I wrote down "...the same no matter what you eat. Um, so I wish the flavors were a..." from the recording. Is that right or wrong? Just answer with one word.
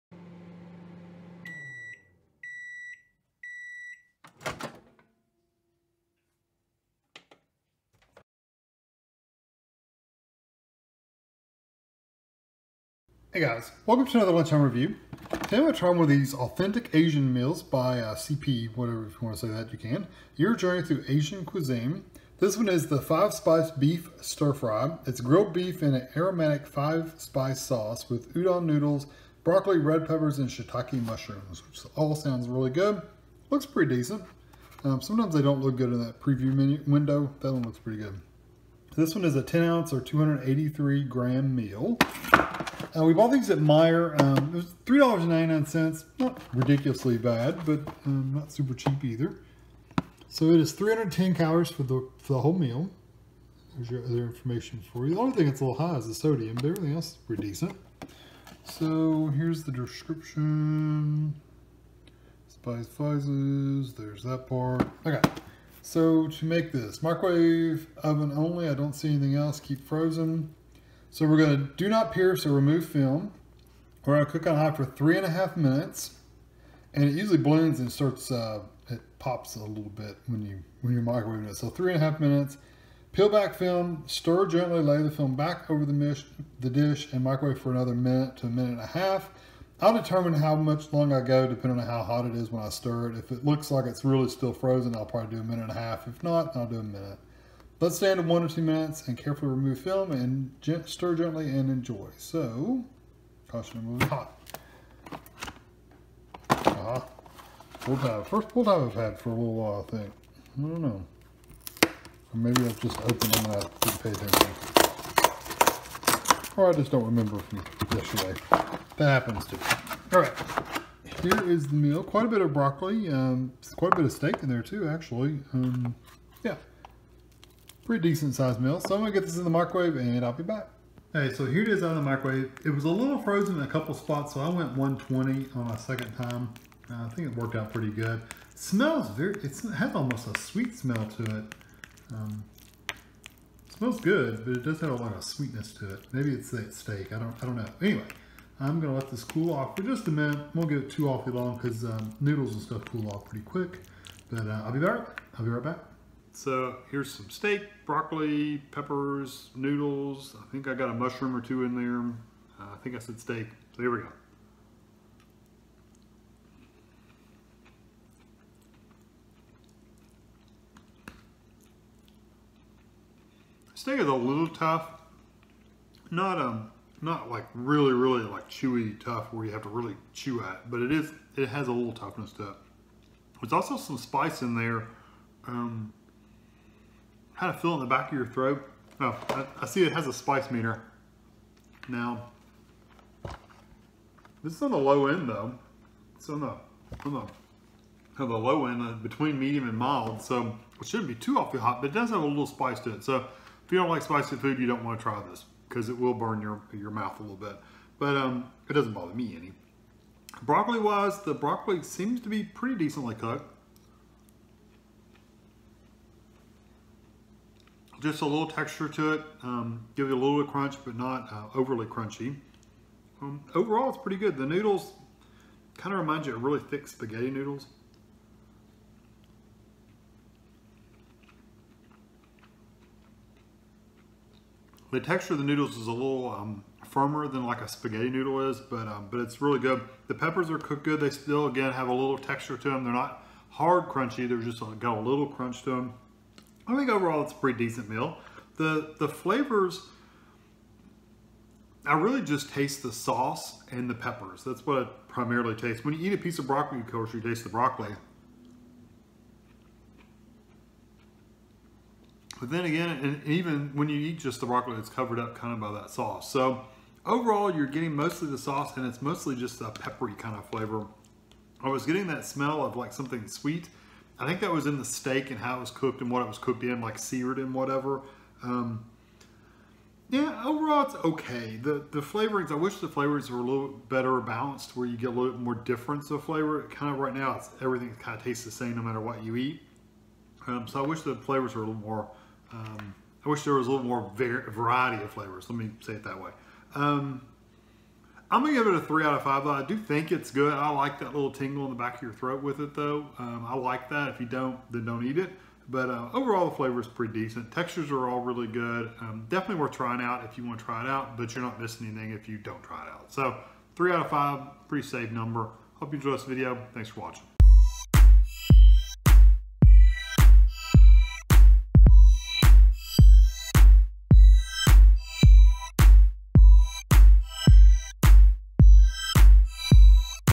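right.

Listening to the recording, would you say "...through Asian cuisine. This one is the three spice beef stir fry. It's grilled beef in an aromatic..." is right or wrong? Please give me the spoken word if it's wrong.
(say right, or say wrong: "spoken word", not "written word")
wrong: "five", not "three".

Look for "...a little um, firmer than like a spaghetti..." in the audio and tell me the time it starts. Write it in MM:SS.
03:55.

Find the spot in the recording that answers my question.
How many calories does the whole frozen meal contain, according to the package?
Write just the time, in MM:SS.
00:50.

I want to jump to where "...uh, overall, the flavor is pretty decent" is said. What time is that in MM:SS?
05:05.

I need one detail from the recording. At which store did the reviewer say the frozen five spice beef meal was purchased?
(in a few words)
Meijer.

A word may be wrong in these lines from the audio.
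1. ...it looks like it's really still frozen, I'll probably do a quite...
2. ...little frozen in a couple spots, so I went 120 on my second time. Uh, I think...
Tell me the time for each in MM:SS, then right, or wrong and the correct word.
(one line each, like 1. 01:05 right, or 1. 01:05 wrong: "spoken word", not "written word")
1. 01:33 wrong: "minute", not "quite"
2. 02:12 right.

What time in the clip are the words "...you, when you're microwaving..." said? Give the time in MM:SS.
01:20.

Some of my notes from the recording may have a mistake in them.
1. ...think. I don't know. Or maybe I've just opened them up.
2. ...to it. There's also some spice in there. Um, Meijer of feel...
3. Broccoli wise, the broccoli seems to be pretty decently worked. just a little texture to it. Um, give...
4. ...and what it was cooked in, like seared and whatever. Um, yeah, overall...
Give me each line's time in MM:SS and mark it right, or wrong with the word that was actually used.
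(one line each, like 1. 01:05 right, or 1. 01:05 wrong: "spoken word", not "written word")
1. 01:49 right
2. 03:02 wrong: "Kind", not "Meijer"
3. 03:30 wrong: "cooked", not "worked"
4. 04:36 right.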